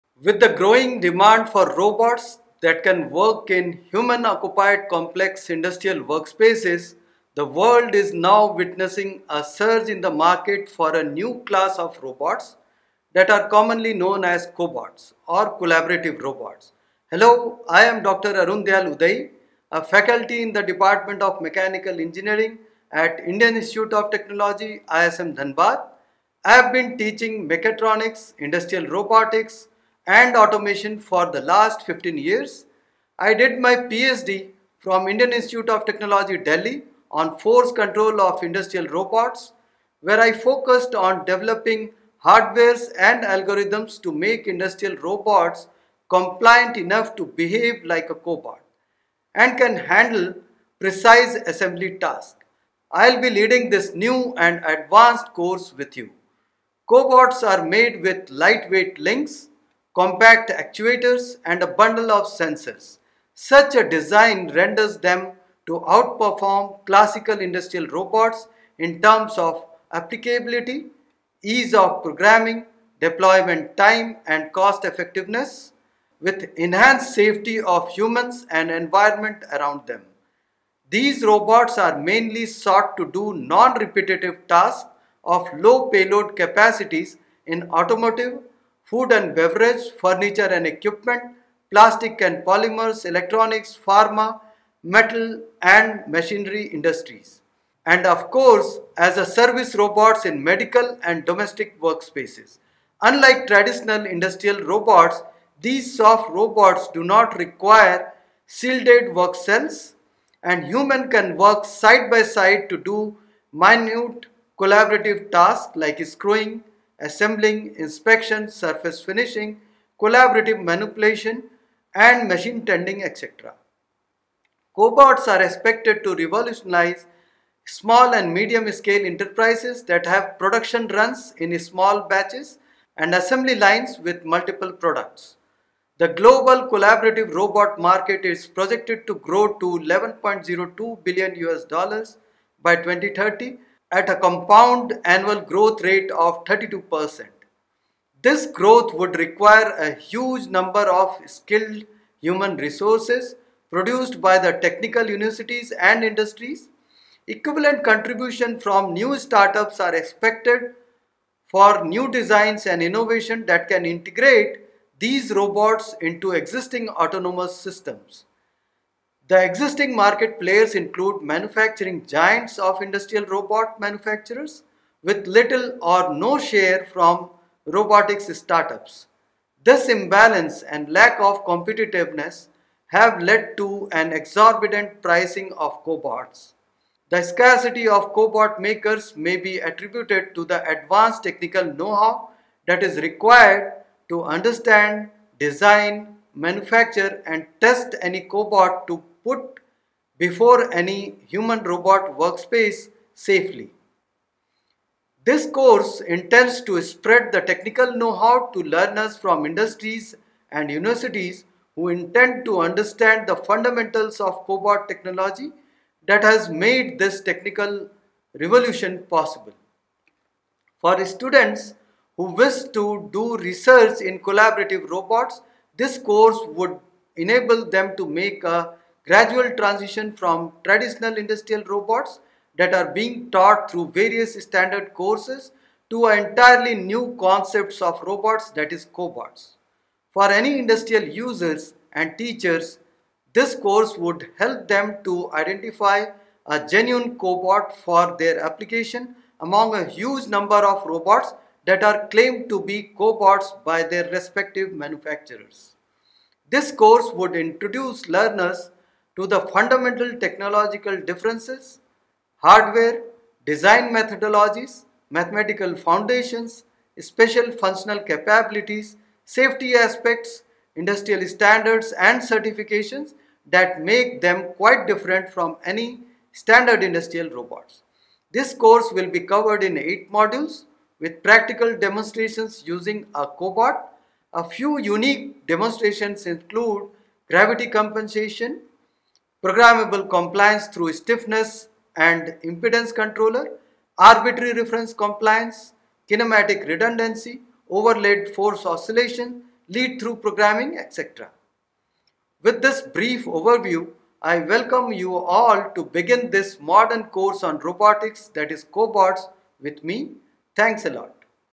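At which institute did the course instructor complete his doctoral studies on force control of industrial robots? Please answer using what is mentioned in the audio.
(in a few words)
Indian Institute of Technology Delhi.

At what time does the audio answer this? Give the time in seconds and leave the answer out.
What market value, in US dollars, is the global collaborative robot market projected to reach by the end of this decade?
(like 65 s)
139 s.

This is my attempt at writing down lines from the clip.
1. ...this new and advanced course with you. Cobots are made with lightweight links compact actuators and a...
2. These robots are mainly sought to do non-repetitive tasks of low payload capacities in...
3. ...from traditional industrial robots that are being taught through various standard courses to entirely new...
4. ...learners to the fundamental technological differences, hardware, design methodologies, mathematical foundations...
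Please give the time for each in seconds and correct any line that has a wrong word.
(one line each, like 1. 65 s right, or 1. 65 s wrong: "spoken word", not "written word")
1. 53 s right
2. 80 s right
3. 230 s right
4. 258 s right.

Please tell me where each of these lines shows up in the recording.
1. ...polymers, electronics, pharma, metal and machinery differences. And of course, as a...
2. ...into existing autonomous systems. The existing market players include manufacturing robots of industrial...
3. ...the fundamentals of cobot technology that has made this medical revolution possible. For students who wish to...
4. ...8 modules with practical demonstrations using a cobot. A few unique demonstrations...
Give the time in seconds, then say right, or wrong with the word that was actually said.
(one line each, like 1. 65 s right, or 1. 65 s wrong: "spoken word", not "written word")
1. 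92 s wrong: "industries", not "differences"
2. 165 s wrong: "giants", not "robots"
3. 213 s wrong: "technical", not "medical"
4. 279 s right.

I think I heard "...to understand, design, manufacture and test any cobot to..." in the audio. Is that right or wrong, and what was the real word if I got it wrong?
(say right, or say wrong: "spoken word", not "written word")
right.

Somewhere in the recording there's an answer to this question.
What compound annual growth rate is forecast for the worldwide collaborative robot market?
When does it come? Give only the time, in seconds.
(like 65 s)
146 s.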